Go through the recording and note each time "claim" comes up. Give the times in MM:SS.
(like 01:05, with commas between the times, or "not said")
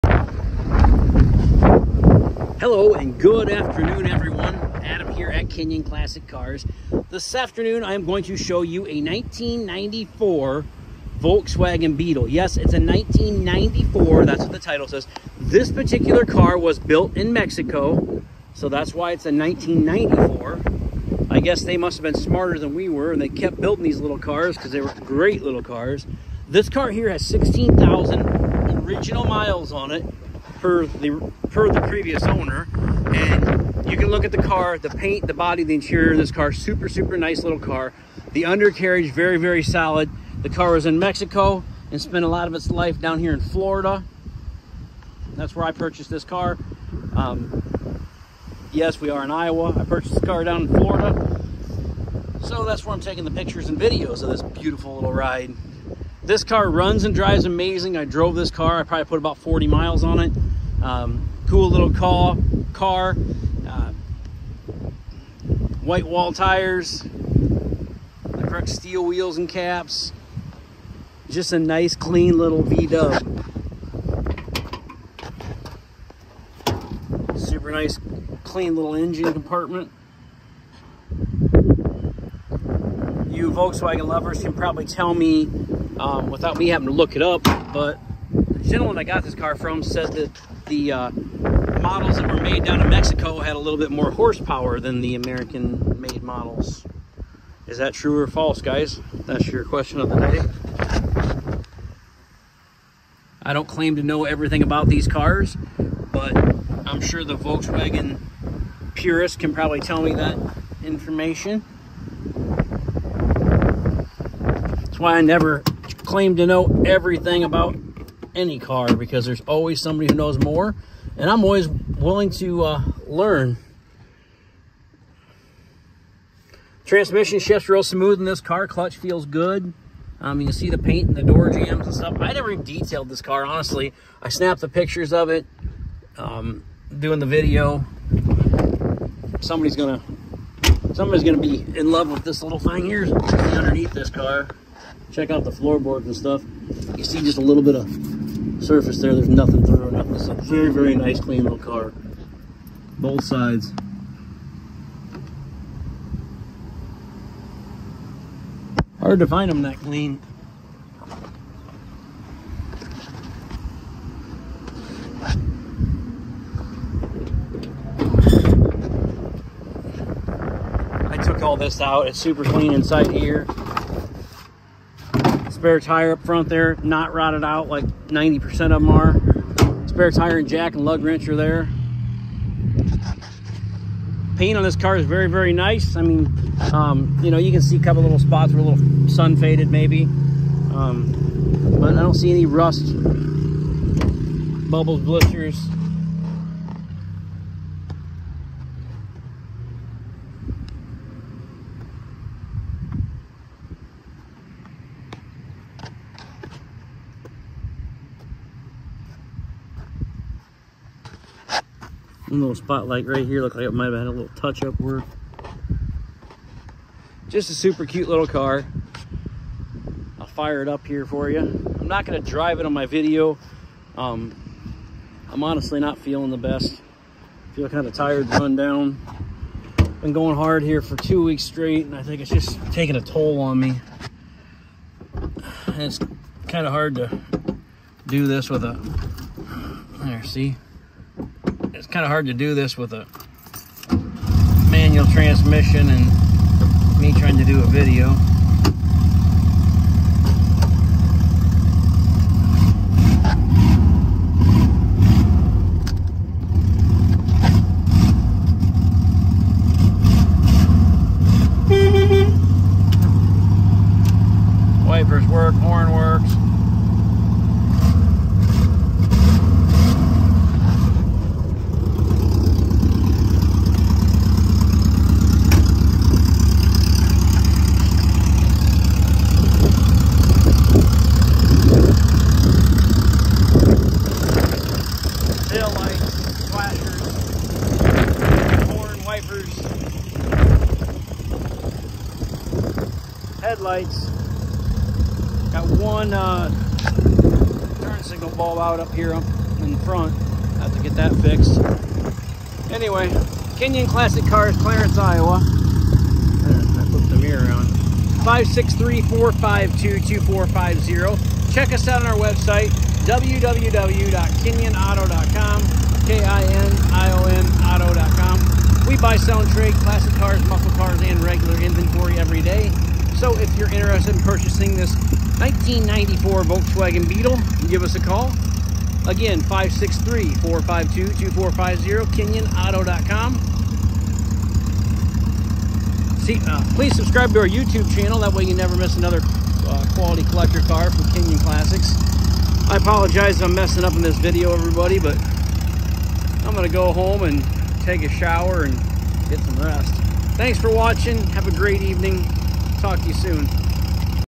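01:43, 01:56.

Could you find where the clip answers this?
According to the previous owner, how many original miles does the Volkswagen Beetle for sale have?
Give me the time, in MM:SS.
00:27.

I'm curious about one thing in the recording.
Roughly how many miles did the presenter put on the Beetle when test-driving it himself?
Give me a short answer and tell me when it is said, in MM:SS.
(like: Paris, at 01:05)
40 miles, at 00:59.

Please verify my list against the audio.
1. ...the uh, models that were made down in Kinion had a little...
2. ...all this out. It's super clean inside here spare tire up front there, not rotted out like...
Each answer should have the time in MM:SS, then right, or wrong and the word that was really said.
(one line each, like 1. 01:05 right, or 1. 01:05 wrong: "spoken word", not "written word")
1. 01:30 wrong: "Mexico", not "Kinion"
2. 02:51 right.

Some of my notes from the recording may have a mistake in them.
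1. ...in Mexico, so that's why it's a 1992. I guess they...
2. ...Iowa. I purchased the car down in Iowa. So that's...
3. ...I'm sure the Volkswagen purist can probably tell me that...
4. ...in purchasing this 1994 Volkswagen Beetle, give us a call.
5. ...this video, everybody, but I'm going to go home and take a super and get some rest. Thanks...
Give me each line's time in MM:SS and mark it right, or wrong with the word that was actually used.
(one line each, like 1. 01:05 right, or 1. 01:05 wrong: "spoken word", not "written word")
1. 00:17 wrong: "1994", not "1992"
2. 00:49 wrong: "Florida", not "Iowa"
3. 01:46 right
4. 05:24 right
5. 05:44 wrong: "shower", not "super".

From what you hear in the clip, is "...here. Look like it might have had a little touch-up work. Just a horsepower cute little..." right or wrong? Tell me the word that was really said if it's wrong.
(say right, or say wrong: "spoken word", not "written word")
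wrong: "super", not "horsepower".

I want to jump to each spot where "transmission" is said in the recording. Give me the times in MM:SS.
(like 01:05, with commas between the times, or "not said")
02:06, 04:05.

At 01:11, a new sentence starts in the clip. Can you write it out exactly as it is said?
Just a nice, clean little V-dub.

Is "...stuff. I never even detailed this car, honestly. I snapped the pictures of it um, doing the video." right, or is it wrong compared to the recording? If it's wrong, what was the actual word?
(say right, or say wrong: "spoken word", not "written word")
right.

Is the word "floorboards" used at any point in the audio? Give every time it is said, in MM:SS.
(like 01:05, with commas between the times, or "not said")
02:25.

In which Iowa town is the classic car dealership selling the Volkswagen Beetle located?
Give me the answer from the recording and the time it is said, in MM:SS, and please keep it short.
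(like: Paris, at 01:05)
Clarence, at 05:04.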